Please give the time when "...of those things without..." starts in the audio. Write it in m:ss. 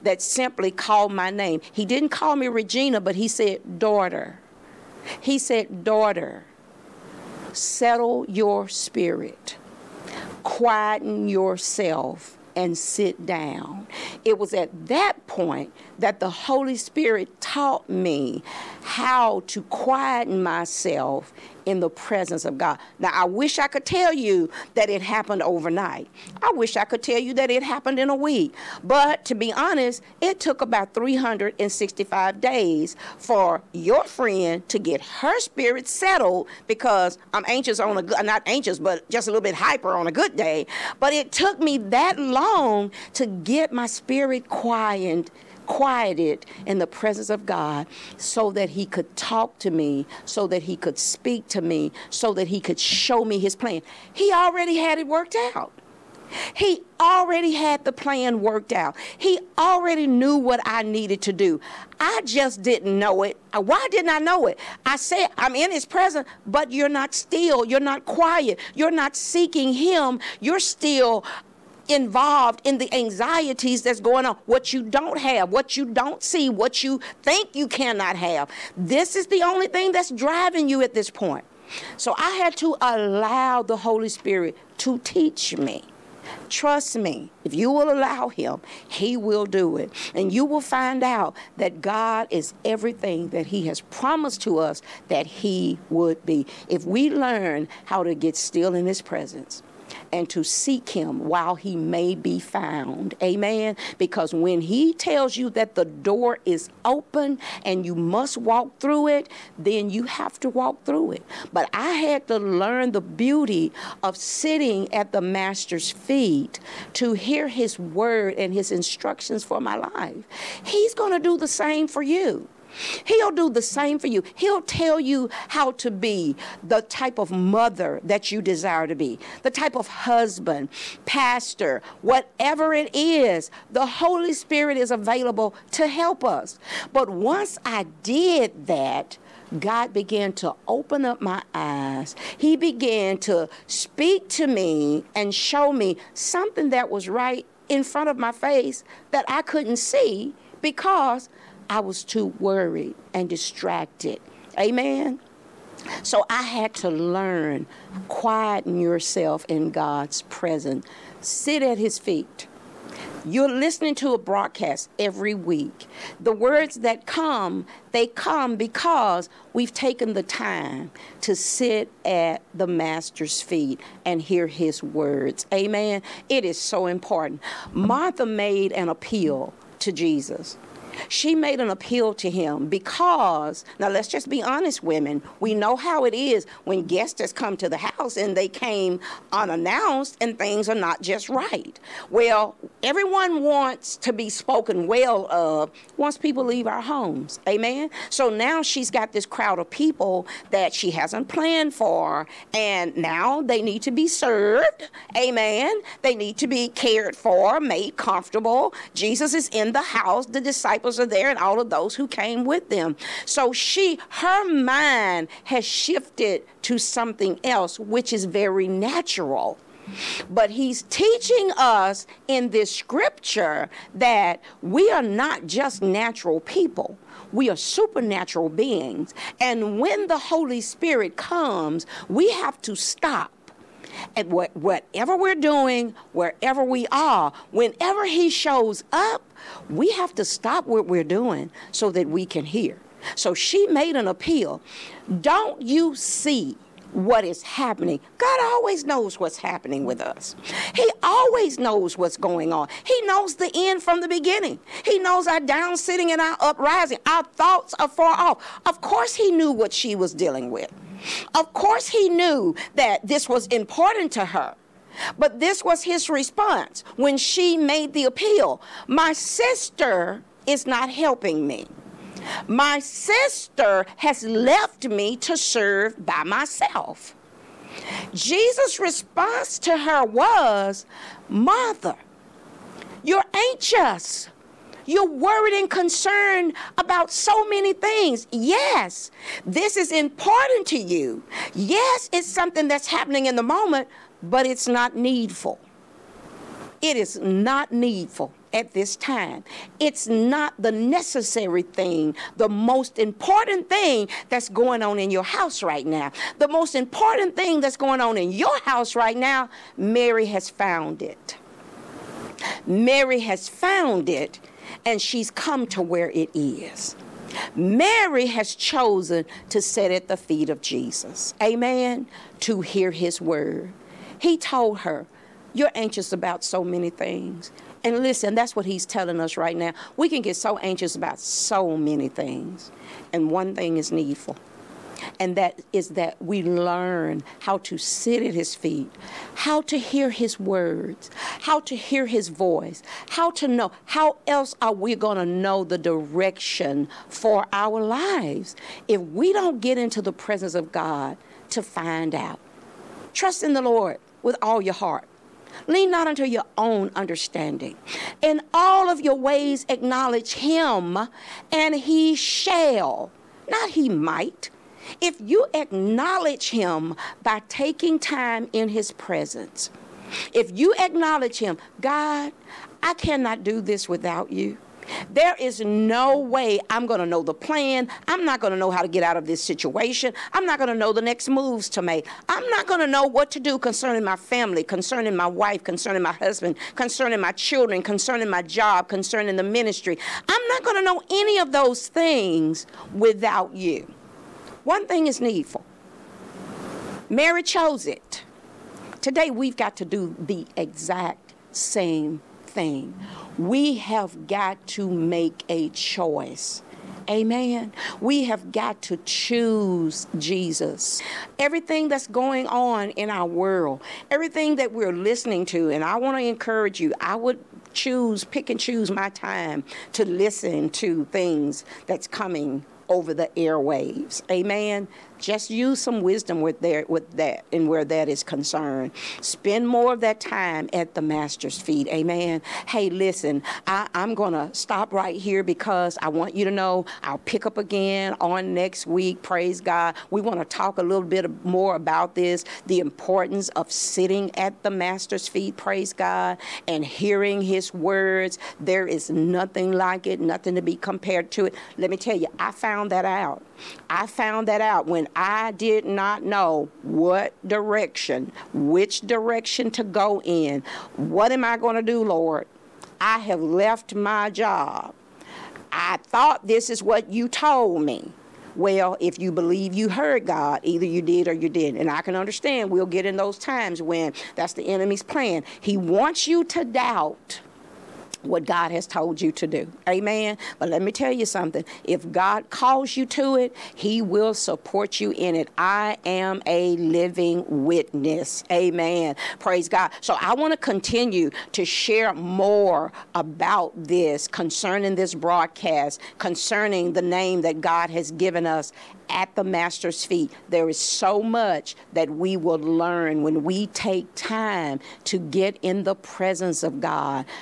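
6:31.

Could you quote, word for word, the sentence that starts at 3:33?
So she, her mind has shifted to something else, which is very natural.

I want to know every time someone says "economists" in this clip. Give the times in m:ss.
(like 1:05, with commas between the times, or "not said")
not said.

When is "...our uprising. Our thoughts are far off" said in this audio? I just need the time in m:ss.
4:16.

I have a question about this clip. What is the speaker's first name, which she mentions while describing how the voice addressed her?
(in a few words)
Regina.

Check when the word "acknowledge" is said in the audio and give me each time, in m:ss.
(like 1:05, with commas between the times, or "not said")
5:59, 6:05, 6:10.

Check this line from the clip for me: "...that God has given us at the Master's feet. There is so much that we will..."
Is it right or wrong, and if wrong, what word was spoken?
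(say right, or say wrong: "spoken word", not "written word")
right.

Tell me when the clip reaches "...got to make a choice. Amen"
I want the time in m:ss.
6:44.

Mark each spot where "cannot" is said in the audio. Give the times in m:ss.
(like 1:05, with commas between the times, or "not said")
1:17, 6:12.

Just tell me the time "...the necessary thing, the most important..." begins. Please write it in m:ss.
5:00.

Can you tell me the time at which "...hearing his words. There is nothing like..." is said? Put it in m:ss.
7:26.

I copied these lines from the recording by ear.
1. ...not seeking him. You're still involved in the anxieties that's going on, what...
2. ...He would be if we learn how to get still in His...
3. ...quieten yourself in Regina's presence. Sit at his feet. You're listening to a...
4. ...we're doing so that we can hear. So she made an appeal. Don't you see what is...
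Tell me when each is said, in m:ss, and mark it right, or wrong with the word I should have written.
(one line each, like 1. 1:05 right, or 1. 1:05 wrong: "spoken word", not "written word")
1. 1:08 right
2. 1:35 right
3. 2:38 wrong: "God", not "Regina"
4. 4:00 right.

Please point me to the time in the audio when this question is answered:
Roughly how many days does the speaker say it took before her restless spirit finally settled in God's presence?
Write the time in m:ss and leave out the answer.
0:30.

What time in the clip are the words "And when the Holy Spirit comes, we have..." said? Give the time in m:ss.
3:49.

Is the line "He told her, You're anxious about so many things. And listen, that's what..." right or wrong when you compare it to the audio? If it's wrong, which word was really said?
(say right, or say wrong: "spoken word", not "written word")
right.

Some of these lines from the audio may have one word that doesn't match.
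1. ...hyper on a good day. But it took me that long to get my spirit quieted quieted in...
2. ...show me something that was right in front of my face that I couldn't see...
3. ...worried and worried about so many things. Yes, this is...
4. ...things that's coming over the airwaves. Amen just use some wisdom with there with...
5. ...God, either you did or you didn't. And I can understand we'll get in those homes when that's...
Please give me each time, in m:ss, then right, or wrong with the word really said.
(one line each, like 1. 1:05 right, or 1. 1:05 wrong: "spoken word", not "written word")
1. 0:39 right
2. 2:25 right
3. 4:45 wrong: "concerned", not "worried"
4. 7:01 right
5. 7:50 wrong: "times", not "homes".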